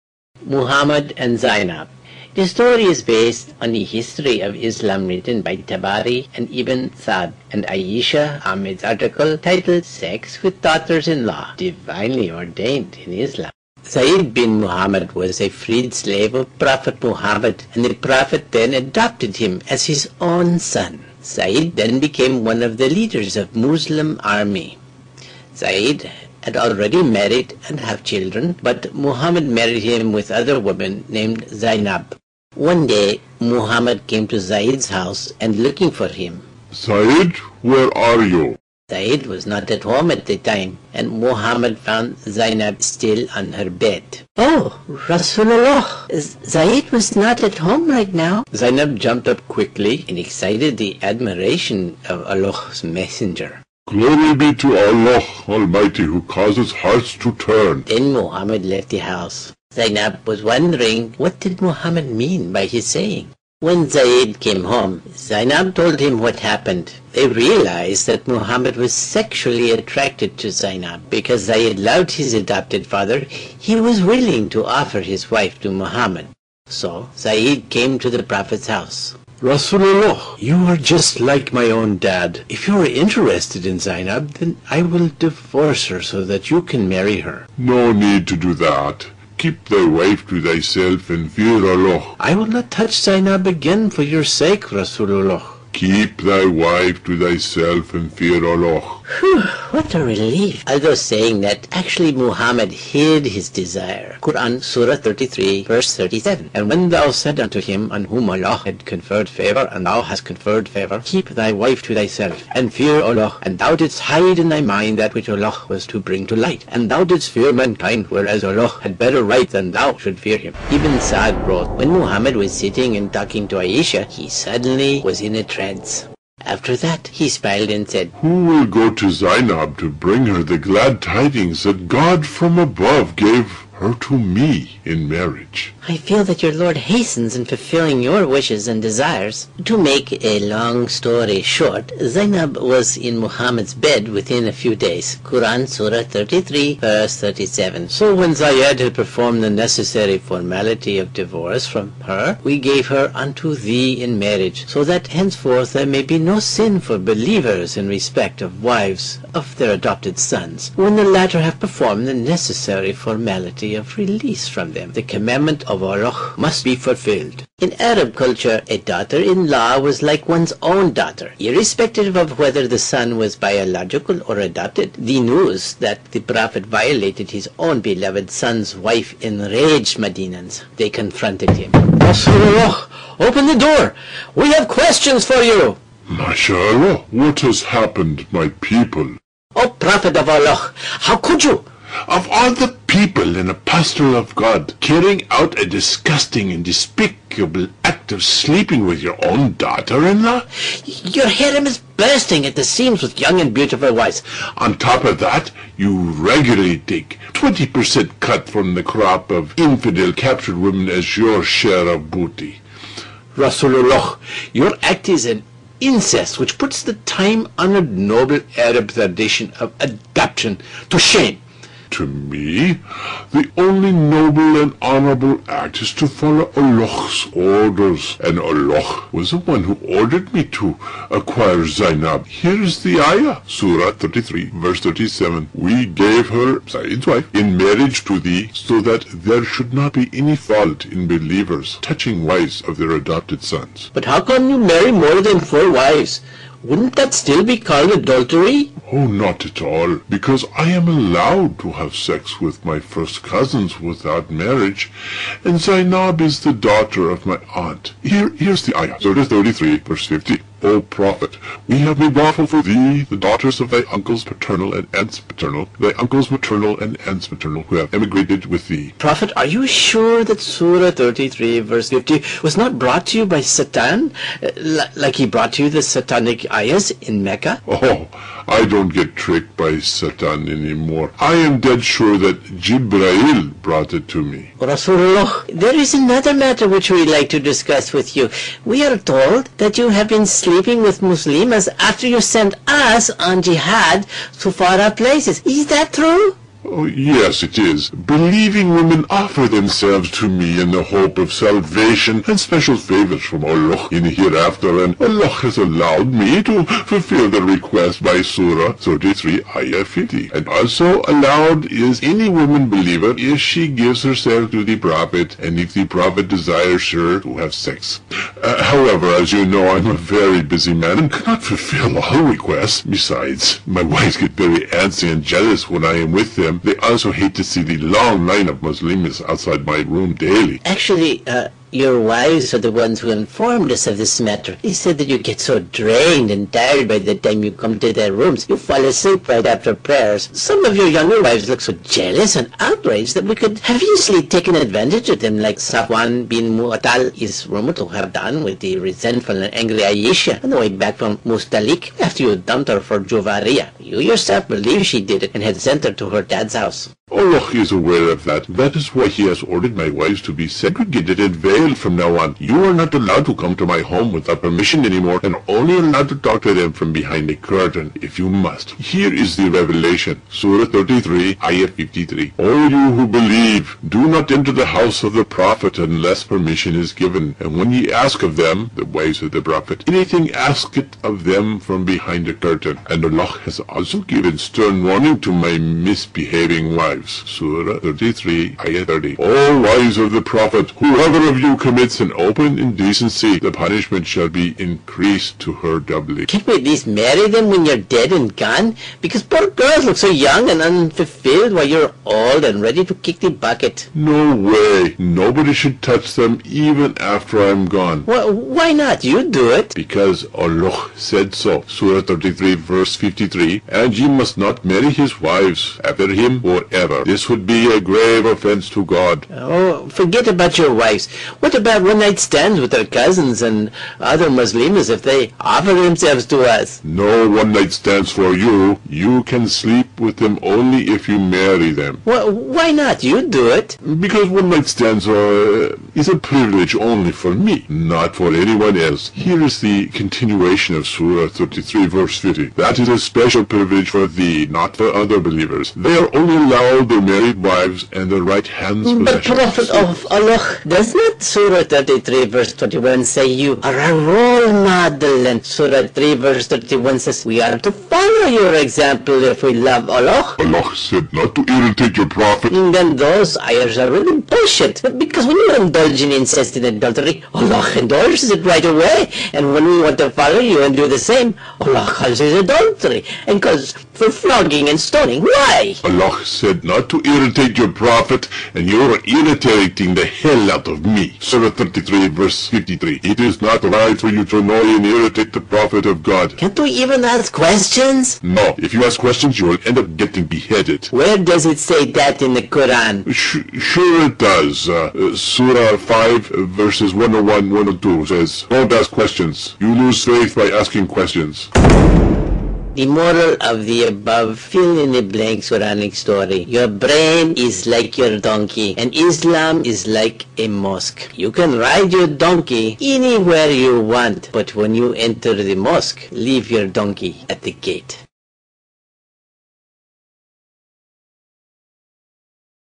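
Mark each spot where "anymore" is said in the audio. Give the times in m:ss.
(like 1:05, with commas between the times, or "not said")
4:40, 6:04.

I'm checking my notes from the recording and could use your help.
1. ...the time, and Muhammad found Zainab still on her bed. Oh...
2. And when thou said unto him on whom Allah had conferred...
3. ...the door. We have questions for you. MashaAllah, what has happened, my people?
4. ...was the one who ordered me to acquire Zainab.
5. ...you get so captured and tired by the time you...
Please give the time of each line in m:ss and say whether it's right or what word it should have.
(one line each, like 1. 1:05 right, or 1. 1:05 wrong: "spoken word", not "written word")
1. 0:40 right
2. 1:46 right
3. 3:03 right
4. 3:49 right
5. 5:35 wrong: "drained", not "captured".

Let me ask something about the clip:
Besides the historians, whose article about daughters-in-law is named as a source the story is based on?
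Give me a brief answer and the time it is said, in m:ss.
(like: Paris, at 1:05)
Ayesha Ahmed, at 0:07.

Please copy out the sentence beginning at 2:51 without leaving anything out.
Irrespective of whether the son was biological or adopted, the news that the Prophet violated his own beloved son's wife enraged Medinans.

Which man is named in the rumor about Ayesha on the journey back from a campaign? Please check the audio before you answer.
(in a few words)
Safwan bin Muatall.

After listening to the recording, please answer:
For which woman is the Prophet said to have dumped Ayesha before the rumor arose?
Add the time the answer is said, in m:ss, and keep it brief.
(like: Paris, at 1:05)
Juvaria, at 5:52.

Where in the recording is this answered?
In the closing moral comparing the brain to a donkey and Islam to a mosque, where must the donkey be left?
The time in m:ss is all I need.
8:37.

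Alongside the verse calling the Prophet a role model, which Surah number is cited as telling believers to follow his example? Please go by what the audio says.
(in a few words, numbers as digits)
Surah 3.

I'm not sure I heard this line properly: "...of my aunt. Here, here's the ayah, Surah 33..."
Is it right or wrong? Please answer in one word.
right.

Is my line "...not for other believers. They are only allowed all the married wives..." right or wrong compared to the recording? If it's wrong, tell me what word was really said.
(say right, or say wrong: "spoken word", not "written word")
right.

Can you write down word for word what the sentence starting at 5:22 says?
Besides, my wives get very antsy and jealous when I am with them them.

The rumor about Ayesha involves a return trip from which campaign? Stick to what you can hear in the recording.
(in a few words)
Mustalik.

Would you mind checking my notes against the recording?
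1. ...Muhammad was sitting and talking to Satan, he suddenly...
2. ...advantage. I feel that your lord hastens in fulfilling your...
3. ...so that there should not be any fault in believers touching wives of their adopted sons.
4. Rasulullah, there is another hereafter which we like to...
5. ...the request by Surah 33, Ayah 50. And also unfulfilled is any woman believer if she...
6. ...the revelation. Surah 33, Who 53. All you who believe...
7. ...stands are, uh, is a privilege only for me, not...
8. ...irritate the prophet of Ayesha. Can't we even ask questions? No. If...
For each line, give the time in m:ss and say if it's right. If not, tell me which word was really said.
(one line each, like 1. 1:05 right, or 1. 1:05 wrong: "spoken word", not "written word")
1. 2:01 wrong: "Aisha", not "Satan"
2. 2:15 wrong: "marriage", not "advantage"
3. 3:58 right
4. 4:44 wrong: "matter", not "hereafter"
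5. 5:07 wrong: "allowed", not "unfulfilled"
6. 6:09 wrong: "Ayah", not "Who"
7. 7:14 right
8. 8:04 wrong: "God", not "Ayesha".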